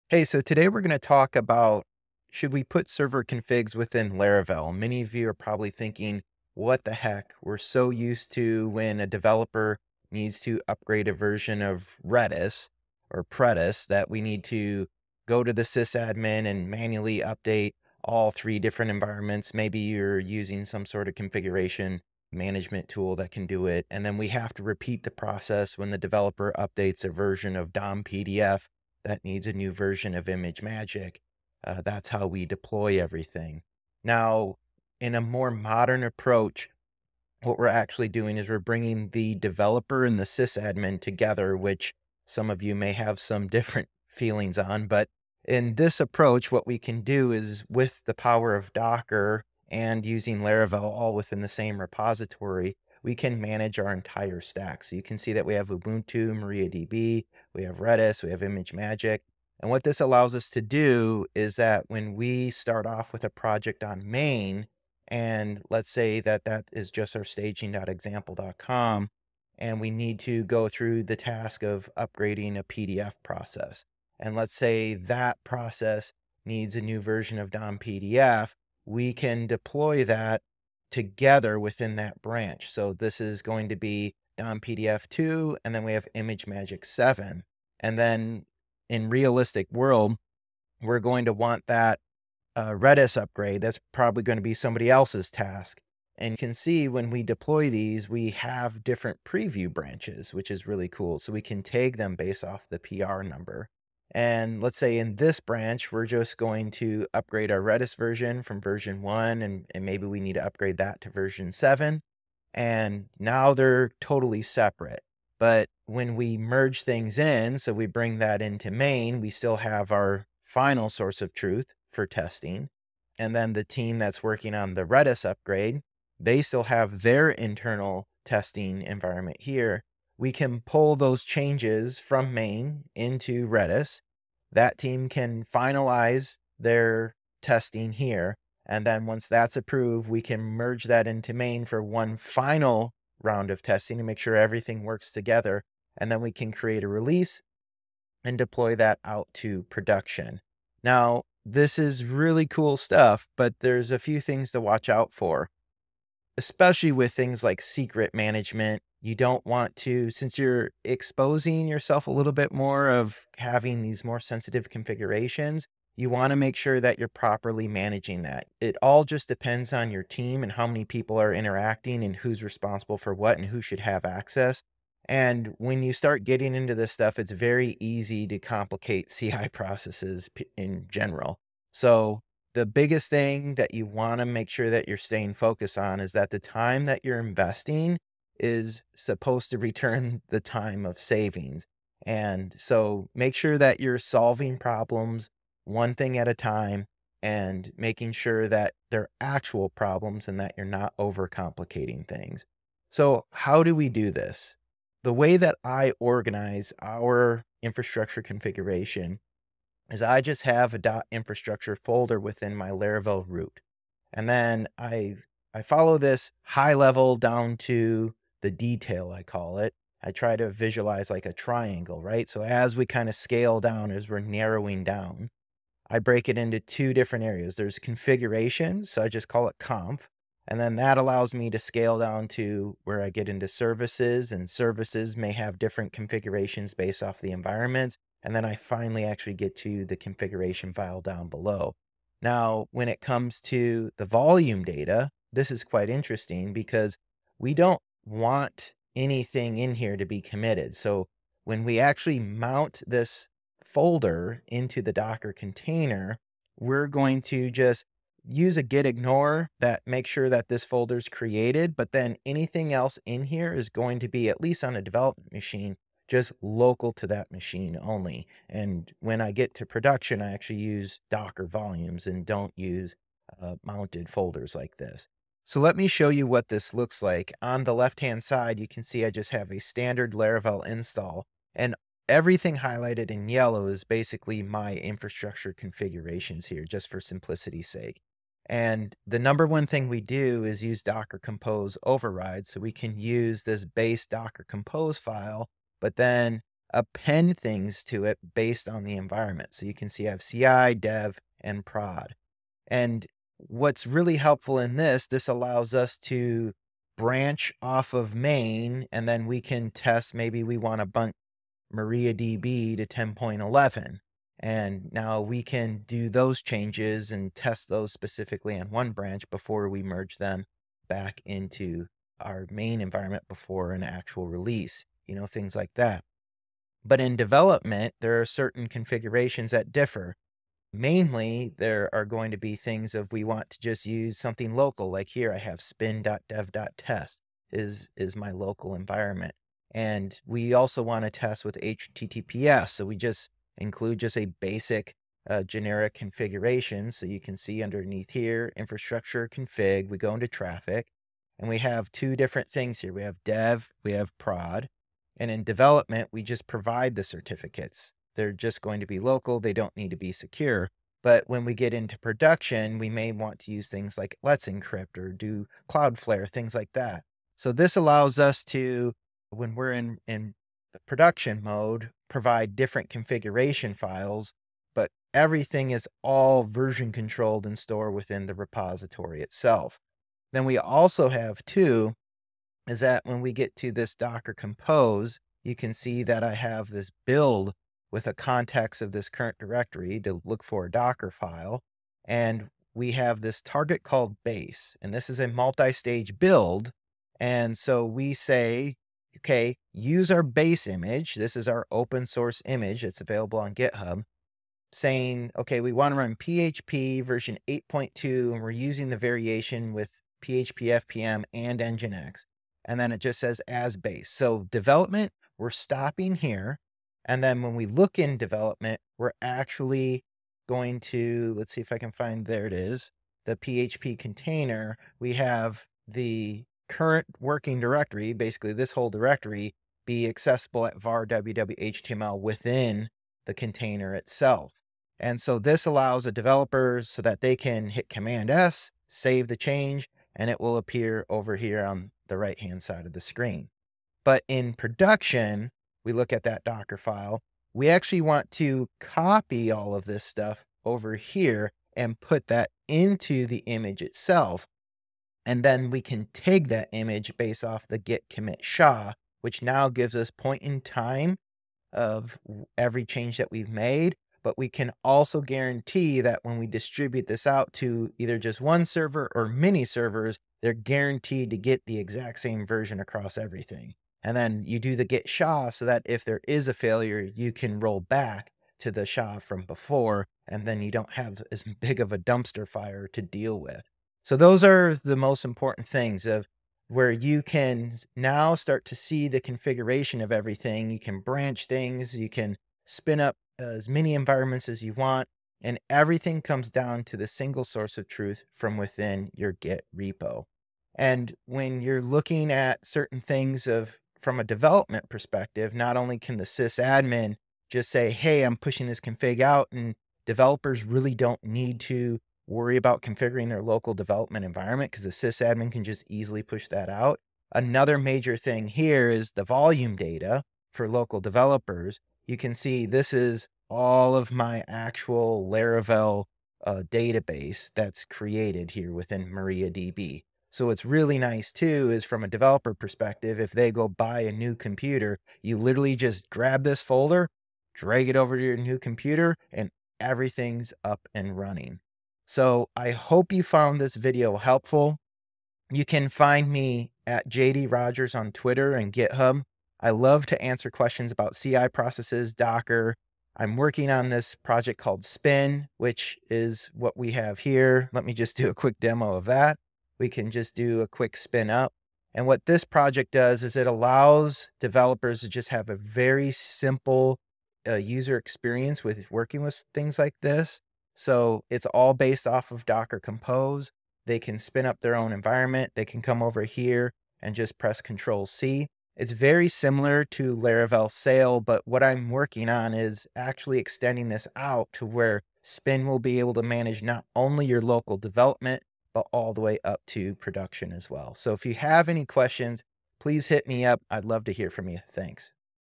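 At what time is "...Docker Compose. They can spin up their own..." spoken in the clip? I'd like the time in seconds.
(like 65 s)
572 s.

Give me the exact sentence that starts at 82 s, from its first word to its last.
So this is going to be DOM PDF 2, and then we have ImageMagick 7.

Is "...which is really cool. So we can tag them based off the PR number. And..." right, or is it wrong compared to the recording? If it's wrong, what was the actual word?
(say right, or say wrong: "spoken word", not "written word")
right.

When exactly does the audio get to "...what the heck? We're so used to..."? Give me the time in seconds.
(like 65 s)
6 s.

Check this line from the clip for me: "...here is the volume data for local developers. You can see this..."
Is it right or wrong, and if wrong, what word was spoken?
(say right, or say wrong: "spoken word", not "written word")
right.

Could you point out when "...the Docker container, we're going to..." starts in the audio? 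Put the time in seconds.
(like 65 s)
254 s.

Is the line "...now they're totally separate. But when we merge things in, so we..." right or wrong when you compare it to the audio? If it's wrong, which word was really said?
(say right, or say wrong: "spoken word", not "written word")
right.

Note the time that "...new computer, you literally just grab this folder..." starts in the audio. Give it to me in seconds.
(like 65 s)
534 s.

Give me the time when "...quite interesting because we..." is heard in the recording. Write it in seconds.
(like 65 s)
245 s.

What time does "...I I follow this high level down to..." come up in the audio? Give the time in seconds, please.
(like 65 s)
214 s.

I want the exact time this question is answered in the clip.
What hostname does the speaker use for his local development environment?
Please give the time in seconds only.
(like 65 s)
335 s.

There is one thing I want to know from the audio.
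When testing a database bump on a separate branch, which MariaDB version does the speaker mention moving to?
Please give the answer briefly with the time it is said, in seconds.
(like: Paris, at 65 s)
10.11, at 312 s.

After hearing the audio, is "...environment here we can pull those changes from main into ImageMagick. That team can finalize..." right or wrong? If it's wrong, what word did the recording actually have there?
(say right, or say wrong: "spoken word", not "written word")
wrong: "Redis", not "ImageMagick".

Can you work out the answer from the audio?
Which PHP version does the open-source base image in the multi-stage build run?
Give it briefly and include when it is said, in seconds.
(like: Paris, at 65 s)
8.2, at 406 s.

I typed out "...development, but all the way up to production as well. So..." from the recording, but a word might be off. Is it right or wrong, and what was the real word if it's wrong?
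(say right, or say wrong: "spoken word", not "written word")
right.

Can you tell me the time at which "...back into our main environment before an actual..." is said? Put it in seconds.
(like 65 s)
320 s.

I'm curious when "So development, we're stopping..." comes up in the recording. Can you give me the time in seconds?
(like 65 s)
414 s.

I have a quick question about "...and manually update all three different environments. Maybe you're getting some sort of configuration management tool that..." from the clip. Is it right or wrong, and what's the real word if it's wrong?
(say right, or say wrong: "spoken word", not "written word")
wrong: "using", not "getting".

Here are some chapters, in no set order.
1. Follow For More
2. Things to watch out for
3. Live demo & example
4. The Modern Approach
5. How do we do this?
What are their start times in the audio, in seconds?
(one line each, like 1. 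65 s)
1. 546 s
2. 150 s
3. 274 s
4. 33 s
5. 203 s.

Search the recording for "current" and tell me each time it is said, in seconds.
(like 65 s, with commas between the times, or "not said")
389 s, 426 s.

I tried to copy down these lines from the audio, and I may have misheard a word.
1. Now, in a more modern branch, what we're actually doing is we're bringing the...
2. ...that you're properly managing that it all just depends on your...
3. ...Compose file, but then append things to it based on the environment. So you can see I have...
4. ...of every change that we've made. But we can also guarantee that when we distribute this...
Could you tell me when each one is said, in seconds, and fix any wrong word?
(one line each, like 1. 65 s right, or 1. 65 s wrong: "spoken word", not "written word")
1. 34 s wrong: "approach", not "branch"
2. 166 s right
3. 294 s right
4. 461 s right.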